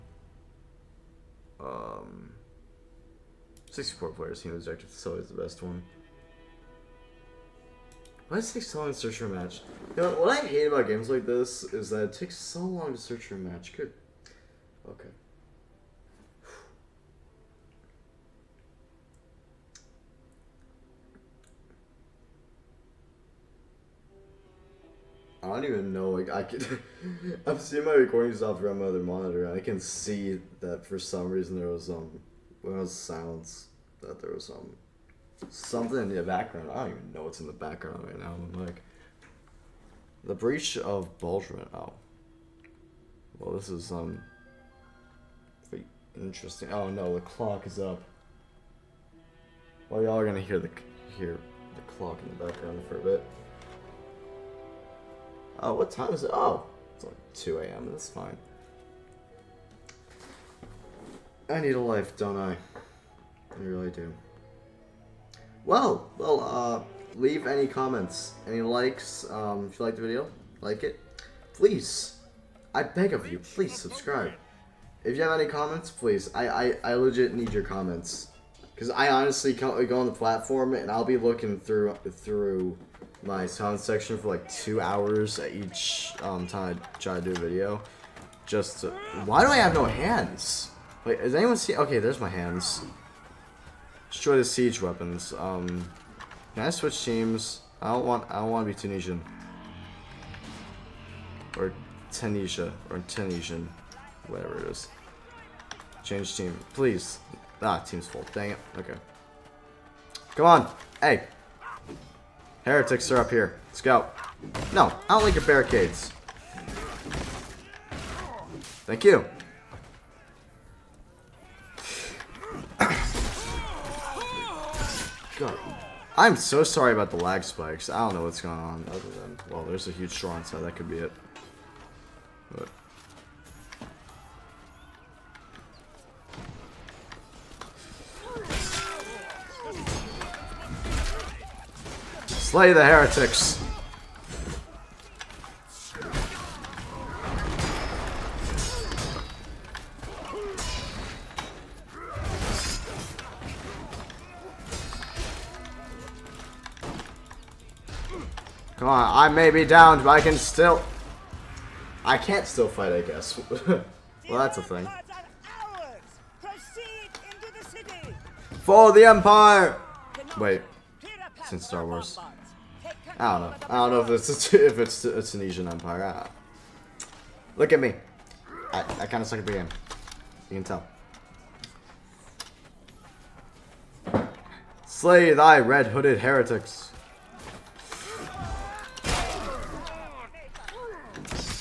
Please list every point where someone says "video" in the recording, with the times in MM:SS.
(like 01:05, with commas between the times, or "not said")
01:10, 01:27.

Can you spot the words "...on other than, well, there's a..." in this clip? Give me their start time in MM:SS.
02:08.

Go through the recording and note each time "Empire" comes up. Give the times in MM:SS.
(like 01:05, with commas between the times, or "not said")
02:49, 02:55.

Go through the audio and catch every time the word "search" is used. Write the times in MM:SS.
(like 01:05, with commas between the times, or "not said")
00:08, 00:12.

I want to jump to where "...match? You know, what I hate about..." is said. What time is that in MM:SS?
00:09.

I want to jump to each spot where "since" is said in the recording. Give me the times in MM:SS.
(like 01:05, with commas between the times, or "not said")
02:51.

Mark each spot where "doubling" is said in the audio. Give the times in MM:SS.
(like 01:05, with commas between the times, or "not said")
not said.